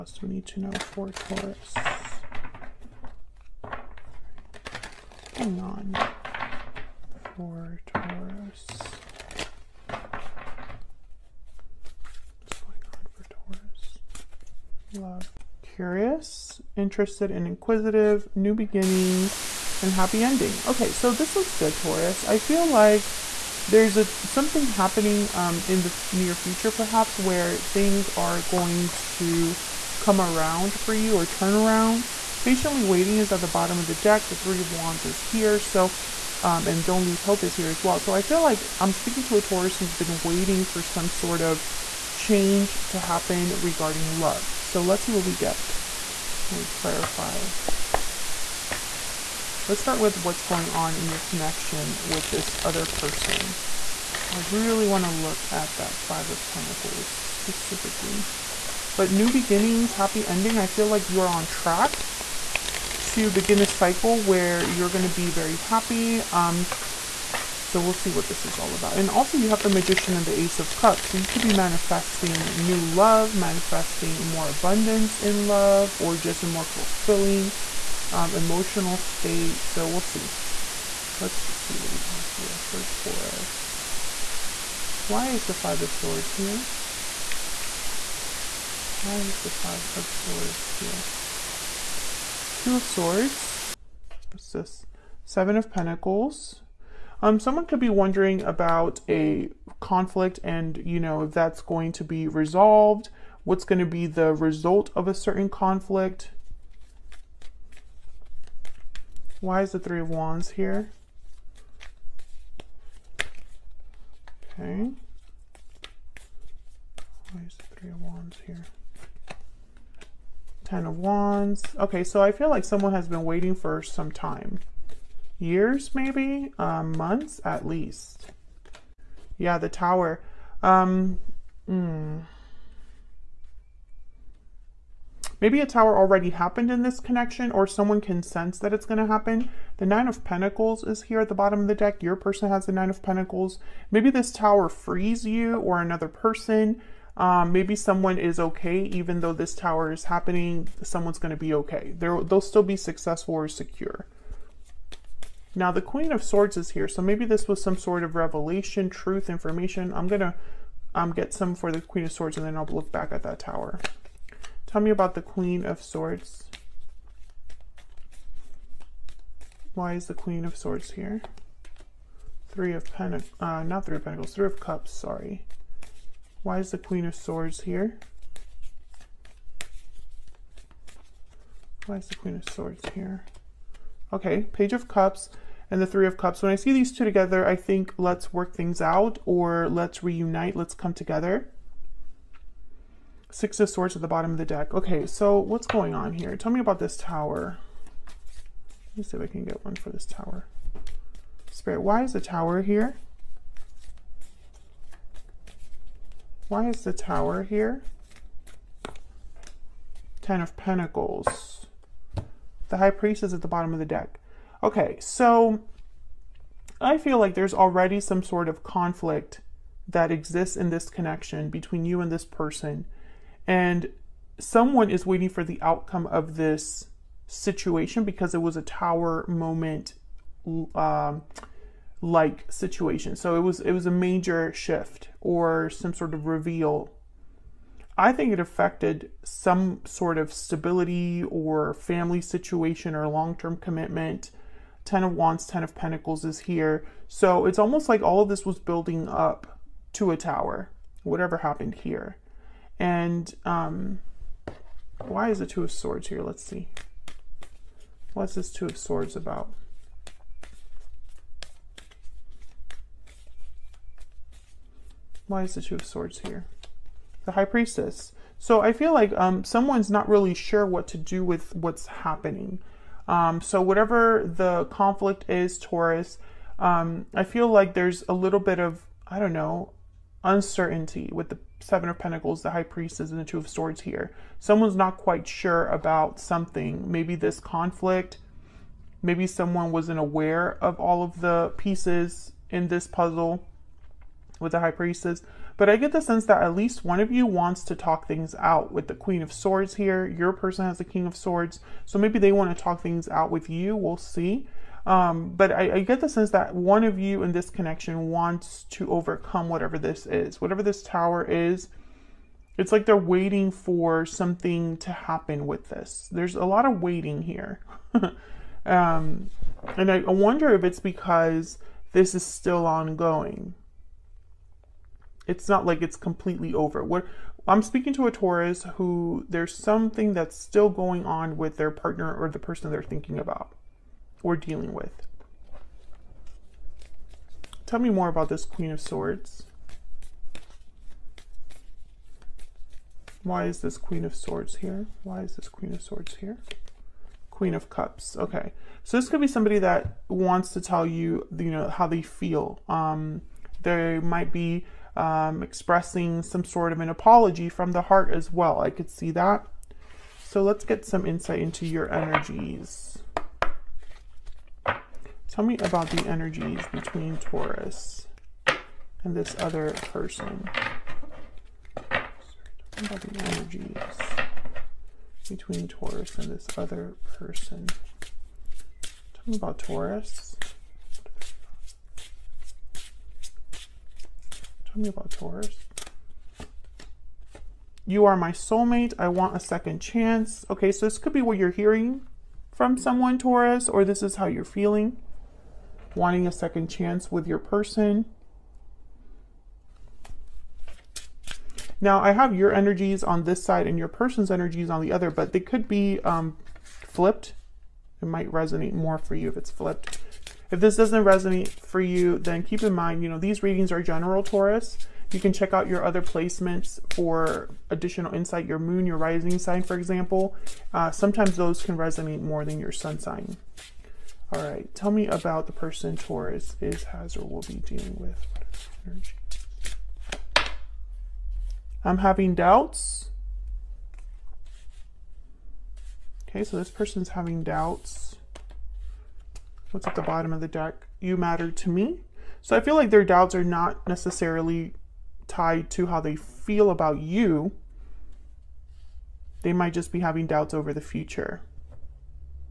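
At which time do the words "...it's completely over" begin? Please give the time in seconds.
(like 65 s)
325 s.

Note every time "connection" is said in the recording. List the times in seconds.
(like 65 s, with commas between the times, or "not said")
51 s, 136 s, 220 s, 307 s.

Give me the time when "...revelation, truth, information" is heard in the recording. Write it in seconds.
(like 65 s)
158 s.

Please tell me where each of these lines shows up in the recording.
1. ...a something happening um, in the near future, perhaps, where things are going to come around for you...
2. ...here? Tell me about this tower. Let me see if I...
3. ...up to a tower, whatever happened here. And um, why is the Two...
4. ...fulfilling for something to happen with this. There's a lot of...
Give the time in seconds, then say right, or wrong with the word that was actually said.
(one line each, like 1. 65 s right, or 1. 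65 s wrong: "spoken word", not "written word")
1. 23 s right
2. 196 s right
3. 249 s right
4. 312 s wrong: "waiting", not "fulfilling".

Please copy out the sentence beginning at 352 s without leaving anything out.
Um, there might be um, expressing some sort of an apology from the heart as well.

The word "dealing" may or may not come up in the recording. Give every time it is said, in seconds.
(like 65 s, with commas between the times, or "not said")
334 s, 427 s.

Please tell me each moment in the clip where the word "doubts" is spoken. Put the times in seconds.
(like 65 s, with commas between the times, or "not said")
432 s, 437 s, 443 s, 450 s.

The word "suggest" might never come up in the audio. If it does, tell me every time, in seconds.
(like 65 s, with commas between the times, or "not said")
not said.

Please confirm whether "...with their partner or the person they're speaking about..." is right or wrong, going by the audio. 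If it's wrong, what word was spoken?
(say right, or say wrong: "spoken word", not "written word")
wrong: "thinking", not "speaking".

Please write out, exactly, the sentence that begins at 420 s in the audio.
Uh, sometimes those can resonate more than your sun sign.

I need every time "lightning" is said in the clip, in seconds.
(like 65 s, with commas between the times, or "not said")
not said.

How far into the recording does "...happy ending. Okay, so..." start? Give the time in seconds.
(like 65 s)
19 s.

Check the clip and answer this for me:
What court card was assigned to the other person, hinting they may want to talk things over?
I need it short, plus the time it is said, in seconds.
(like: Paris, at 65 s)
King of Swords, at 300 s.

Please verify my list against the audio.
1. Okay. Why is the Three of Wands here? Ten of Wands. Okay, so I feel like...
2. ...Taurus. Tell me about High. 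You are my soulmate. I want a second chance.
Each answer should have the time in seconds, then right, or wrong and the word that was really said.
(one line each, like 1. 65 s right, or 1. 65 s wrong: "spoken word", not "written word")
1. 114 s right
2. 379 s wrong: "Taurus", not "High".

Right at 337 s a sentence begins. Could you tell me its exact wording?
Tell me more about this Queen of Swords.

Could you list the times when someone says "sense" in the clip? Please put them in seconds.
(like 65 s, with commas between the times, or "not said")
138 s, 296 s, 306 s.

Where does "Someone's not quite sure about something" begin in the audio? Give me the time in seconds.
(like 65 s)
284 s.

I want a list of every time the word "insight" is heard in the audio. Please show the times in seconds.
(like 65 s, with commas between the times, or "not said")
361 s, 418 s.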